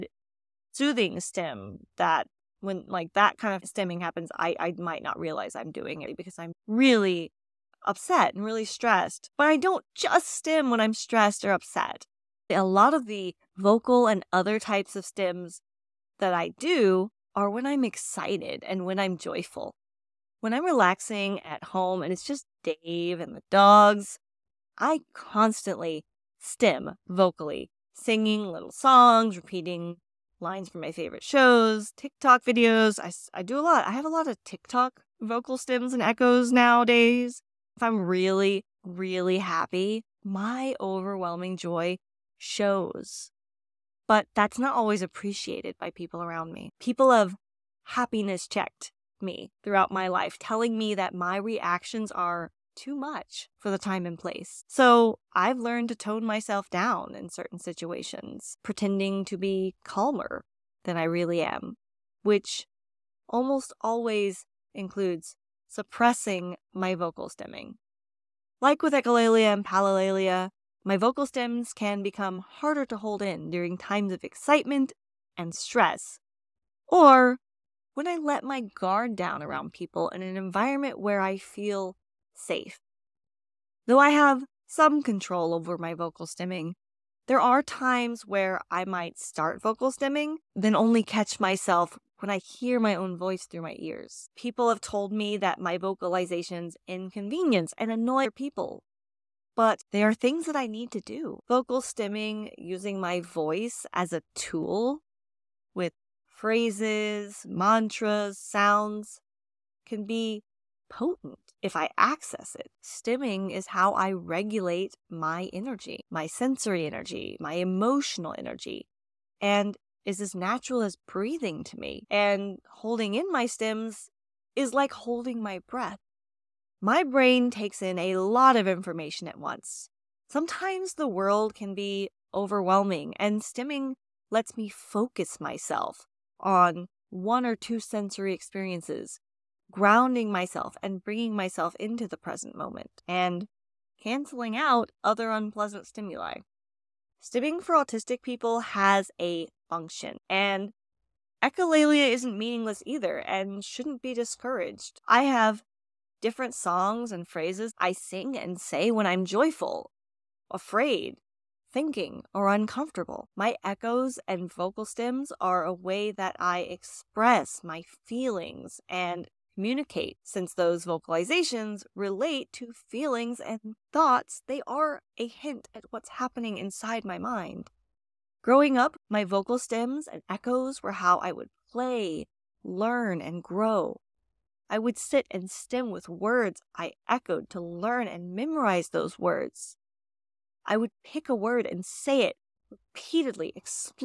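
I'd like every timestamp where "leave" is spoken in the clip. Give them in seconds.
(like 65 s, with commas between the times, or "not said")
not said.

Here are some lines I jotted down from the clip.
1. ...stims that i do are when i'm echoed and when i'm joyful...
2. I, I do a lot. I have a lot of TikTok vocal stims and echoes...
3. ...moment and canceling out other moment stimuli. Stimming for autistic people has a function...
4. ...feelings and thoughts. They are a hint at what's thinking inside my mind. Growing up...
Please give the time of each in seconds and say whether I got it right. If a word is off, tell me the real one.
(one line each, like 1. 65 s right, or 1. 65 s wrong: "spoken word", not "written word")
1. 15 s wrong: "excited", not "echoed"
2. 32 s right
3. 142 s wrong: "unpleasant", not "moment"
4. 172 s wrong: "happening", not "thinking".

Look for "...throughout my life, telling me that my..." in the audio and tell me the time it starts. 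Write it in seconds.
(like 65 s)
49 s.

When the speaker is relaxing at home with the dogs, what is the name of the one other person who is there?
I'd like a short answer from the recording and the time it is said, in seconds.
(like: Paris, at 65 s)
Dave, at 22 s.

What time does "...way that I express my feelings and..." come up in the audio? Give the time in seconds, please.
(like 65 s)
165 s.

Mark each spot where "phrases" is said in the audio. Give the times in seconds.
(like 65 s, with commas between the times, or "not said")
106 s, 157 s.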